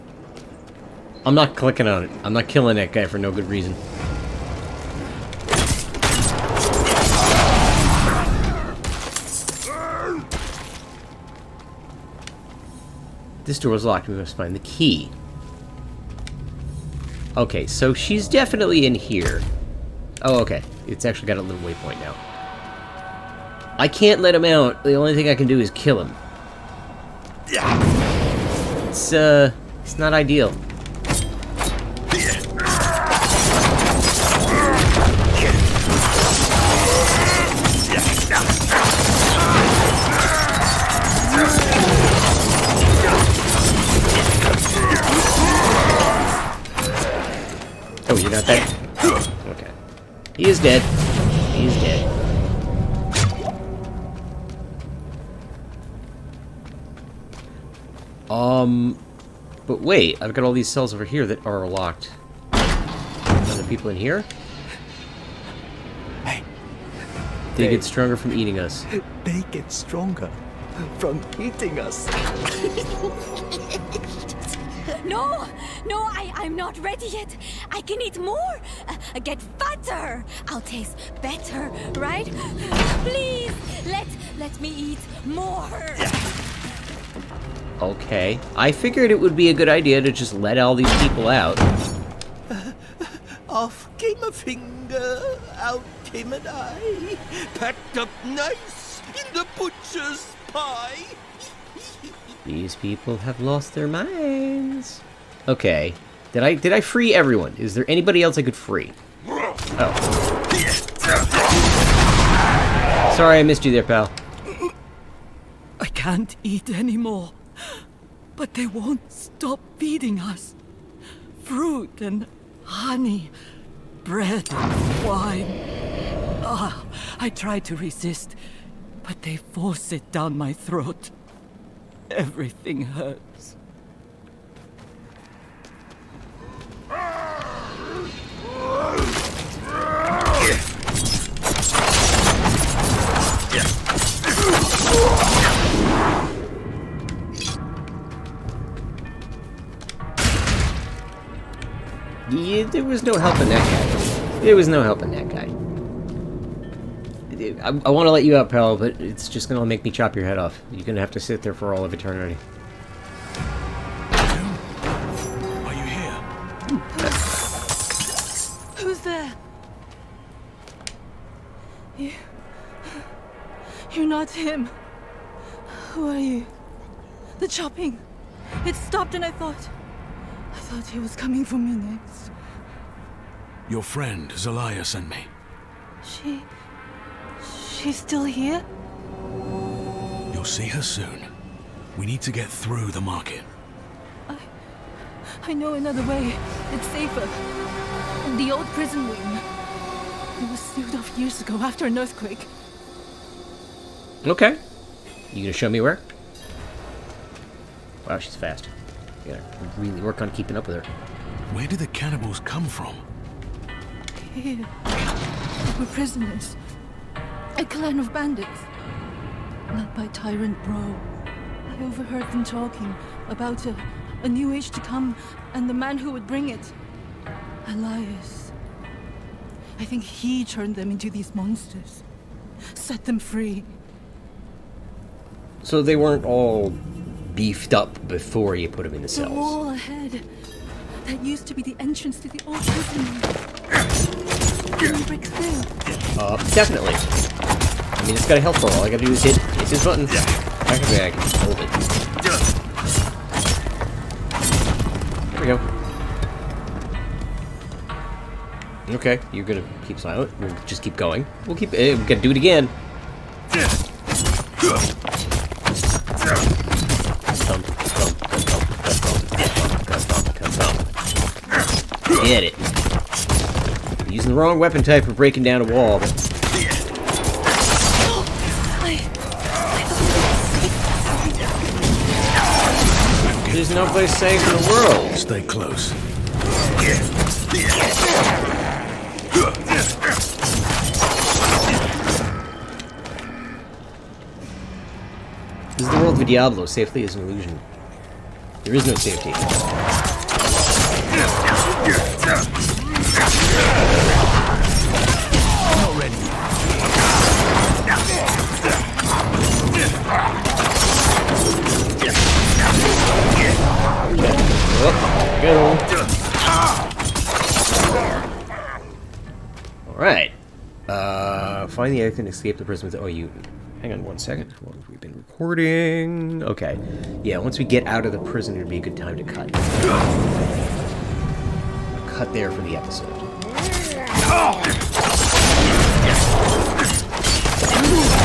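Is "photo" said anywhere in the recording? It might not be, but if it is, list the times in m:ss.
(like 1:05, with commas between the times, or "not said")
not said.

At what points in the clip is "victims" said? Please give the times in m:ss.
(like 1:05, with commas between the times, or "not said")
not said.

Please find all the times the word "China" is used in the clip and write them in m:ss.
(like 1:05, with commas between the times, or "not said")
not said.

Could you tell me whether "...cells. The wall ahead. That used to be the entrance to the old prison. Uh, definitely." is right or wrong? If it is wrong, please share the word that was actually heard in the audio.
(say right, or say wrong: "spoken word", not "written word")
right.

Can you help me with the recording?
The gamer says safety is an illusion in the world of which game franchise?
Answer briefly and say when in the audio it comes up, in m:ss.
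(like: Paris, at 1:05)
Diablo, at 4:56.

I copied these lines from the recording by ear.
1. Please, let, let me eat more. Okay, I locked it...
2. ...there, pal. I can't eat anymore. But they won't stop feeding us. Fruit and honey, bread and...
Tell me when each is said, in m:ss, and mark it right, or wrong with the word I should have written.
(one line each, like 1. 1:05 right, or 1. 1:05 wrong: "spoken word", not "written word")
1. 1:23 wrong: "figured", not "locked"
2. 1:53 right.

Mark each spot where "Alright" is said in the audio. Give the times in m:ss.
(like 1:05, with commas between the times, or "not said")
5:19.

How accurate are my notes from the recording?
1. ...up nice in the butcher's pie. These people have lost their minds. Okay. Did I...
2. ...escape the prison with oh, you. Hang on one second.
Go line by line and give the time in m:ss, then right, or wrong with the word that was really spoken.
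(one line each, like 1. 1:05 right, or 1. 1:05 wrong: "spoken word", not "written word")
1. 1:37 right
2. 5:22 right.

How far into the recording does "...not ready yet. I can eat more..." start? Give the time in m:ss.
1:16.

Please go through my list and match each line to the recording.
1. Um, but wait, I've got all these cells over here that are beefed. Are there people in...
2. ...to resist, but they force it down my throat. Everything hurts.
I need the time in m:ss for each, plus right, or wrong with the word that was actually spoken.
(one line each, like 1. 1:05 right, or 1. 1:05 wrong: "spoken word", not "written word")
1. 0:58 wrong: "locked", not "beefed"
2. 2:07 right.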